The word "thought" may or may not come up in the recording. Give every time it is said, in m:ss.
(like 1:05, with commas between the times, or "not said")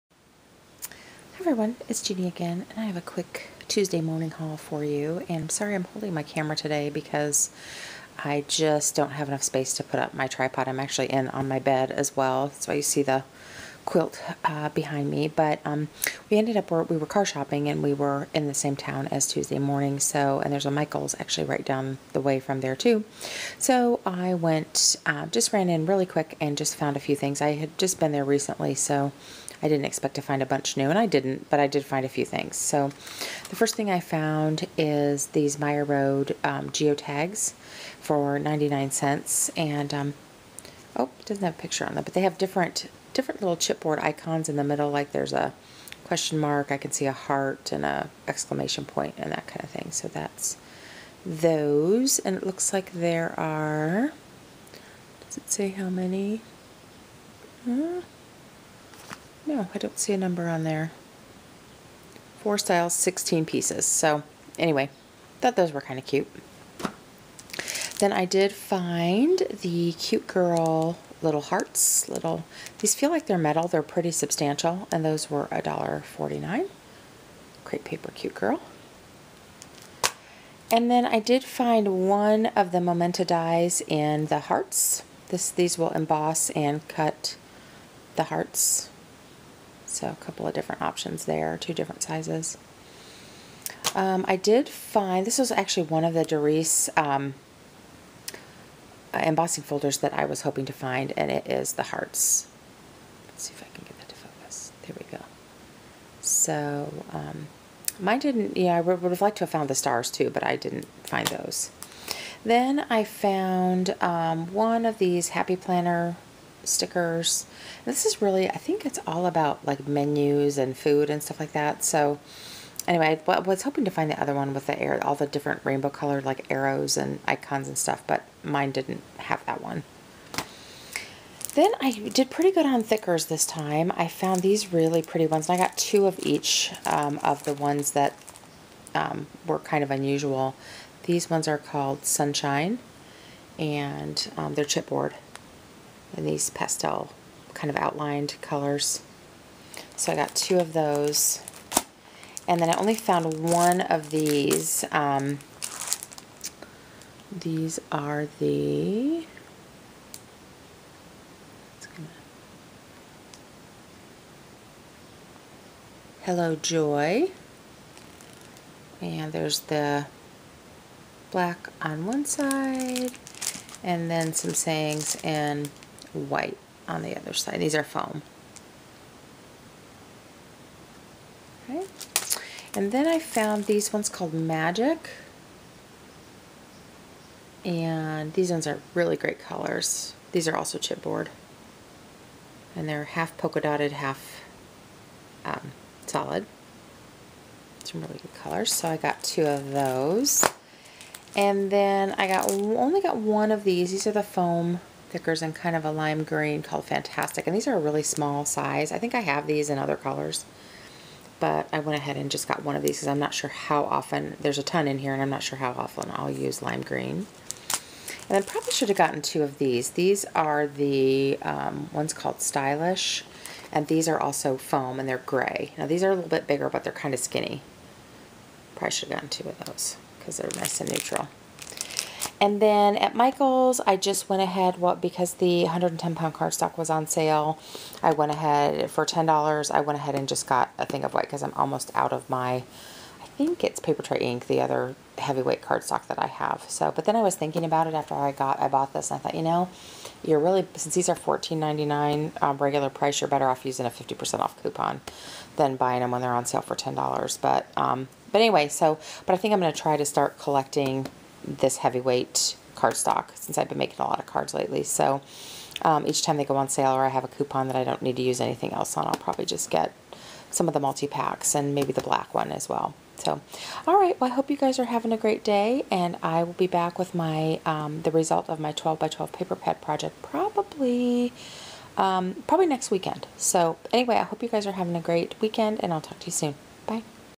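1:05, 4:09.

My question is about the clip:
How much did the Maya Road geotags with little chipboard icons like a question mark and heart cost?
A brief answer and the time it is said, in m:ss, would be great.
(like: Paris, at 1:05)
99 cents, at 0:38.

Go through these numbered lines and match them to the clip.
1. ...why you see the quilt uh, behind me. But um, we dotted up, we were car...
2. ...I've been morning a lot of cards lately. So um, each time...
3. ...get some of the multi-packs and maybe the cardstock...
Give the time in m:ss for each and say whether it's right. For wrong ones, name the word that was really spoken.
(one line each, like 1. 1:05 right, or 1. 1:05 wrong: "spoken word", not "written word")
1. 0:12 wrong: "ended", not "dotted"
2. 4:23 wrong: "making", not "morning"
3. 4:29 wrong: "black", not "cardstock".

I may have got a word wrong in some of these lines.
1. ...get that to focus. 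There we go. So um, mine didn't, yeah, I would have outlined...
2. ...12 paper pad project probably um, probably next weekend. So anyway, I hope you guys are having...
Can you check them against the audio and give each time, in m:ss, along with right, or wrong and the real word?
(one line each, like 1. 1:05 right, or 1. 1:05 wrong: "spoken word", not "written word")
1. 1:43 wrong: "liked", not "outlined"
2. 4:39 right.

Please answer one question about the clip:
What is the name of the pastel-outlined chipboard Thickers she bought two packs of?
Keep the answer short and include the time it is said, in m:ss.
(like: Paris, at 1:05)
Sunshine, at 2:22.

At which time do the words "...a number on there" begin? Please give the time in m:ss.
1:00.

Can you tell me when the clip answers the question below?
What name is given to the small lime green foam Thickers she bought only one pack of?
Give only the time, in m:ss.
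3:26.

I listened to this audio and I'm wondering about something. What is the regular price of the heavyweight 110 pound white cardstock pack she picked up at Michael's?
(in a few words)
$14.99.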